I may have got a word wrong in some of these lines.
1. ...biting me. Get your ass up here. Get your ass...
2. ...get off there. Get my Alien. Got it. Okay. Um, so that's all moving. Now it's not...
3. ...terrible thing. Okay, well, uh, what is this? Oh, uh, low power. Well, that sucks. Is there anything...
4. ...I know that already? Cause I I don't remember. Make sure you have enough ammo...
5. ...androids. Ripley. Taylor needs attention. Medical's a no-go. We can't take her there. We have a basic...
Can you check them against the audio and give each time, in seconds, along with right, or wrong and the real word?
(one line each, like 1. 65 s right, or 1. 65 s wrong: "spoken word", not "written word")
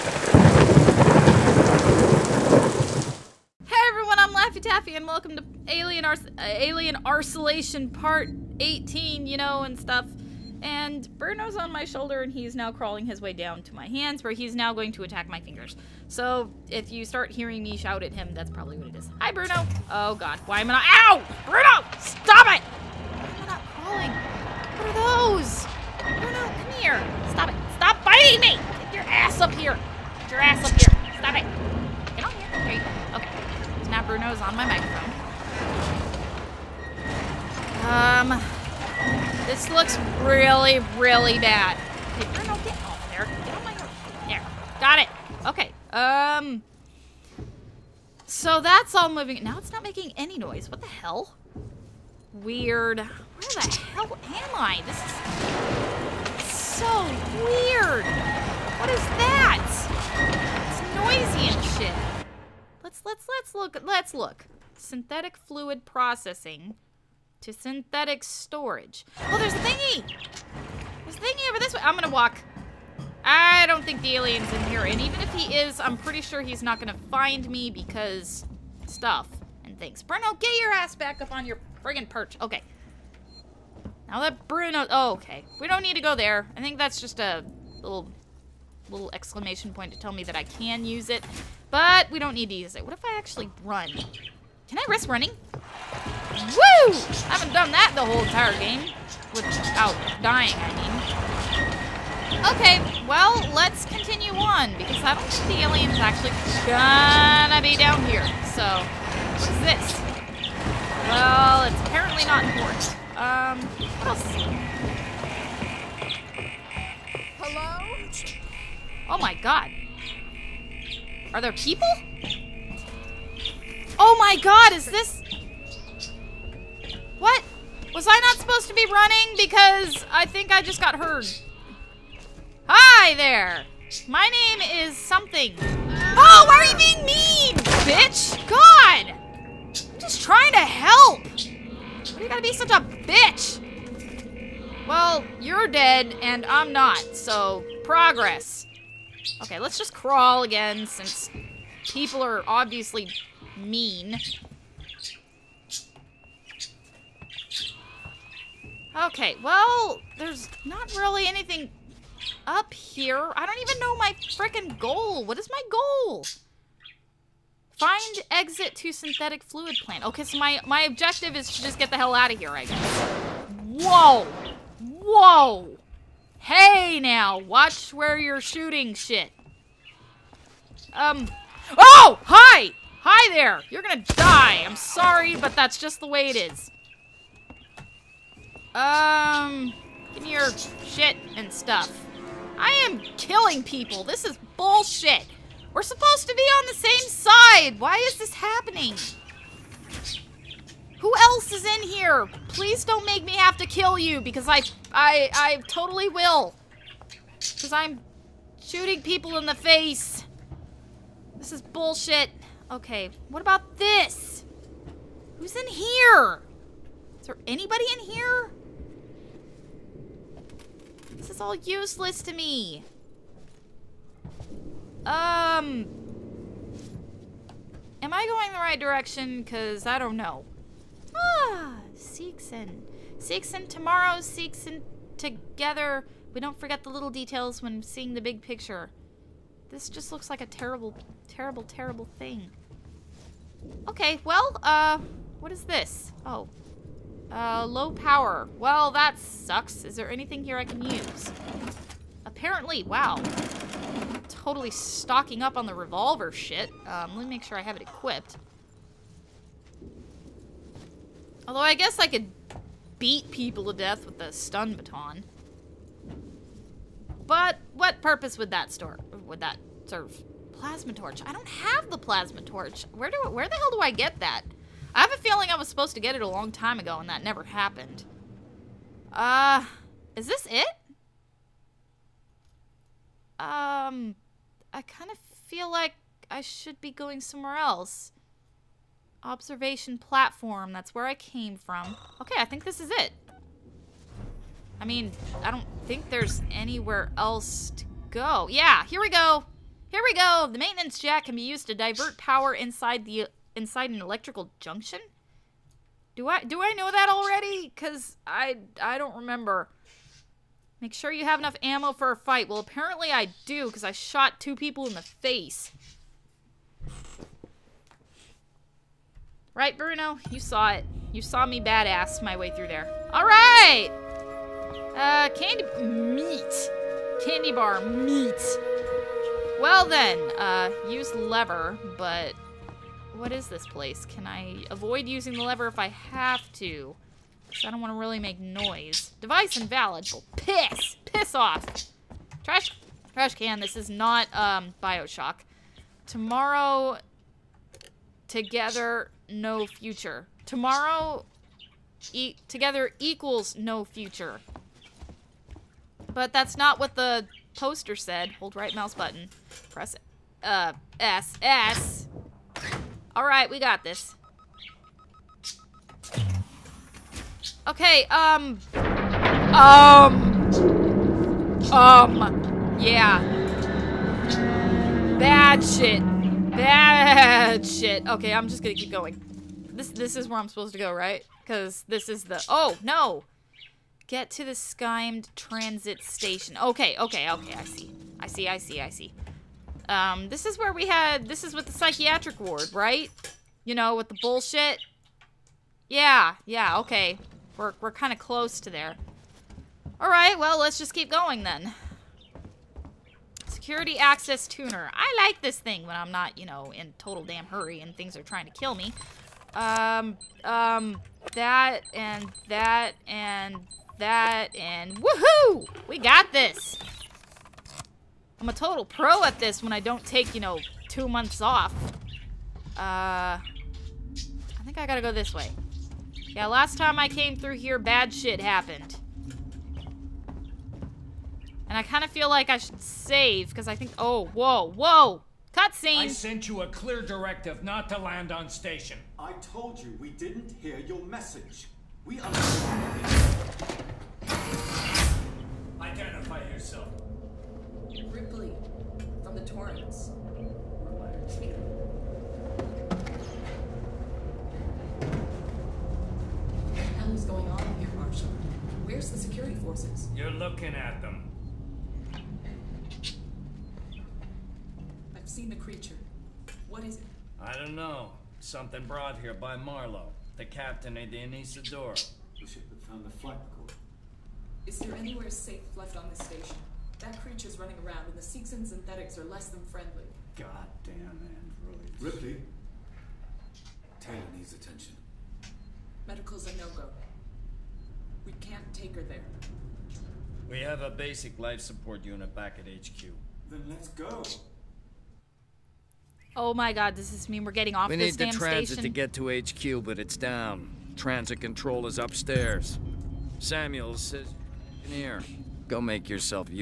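1. 28 s right
2. 42 s wrong: "There", not "Alien"
3. 241 s right
4. 306 s right
5. 481 s right.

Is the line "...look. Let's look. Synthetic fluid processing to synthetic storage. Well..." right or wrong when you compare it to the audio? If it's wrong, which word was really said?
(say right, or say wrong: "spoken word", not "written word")
right.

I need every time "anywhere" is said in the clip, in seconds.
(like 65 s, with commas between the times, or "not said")
296 s, 474 s.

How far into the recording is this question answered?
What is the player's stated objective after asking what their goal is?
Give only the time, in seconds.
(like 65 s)
167 s.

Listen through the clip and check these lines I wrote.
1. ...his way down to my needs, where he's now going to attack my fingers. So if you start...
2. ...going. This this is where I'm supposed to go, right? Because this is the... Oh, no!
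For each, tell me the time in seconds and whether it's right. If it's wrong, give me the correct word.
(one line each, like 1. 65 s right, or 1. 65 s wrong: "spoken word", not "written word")
1. 13 s wrong: "hands", not "needs"
2. 378 s right.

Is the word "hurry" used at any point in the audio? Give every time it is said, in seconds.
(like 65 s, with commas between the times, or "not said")
407 s.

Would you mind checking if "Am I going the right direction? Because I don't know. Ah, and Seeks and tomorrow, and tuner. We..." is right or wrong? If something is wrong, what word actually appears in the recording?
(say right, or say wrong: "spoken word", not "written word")
wrong: "together", not "tuner".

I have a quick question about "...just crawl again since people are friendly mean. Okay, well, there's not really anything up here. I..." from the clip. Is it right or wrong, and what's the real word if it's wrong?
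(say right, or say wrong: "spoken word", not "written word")
wrong: "obviously", not "friendly".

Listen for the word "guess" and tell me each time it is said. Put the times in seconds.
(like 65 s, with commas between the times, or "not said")
172 s, 261 s.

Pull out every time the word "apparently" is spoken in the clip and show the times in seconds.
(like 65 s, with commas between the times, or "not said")
111 s, 252 s, 312 s.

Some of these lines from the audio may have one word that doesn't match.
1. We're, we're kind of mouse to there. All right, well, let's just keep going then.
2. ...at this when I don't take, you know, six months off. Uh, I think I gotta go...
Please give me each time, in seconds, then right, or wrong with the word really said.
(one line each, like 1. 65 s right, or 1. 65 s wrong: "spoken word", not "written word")
1. 397 s wrong: "close", not "mouse"
2. 419 s wrong: "two", not "six".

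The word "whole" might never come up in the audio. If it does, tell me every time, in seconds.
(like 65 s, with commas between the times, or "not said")
98 s.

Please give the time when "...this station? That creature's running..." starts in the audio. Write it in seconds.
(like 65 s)
476 s.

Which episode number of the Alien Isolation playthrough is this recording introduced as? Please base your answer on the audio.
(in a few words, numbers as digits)
18.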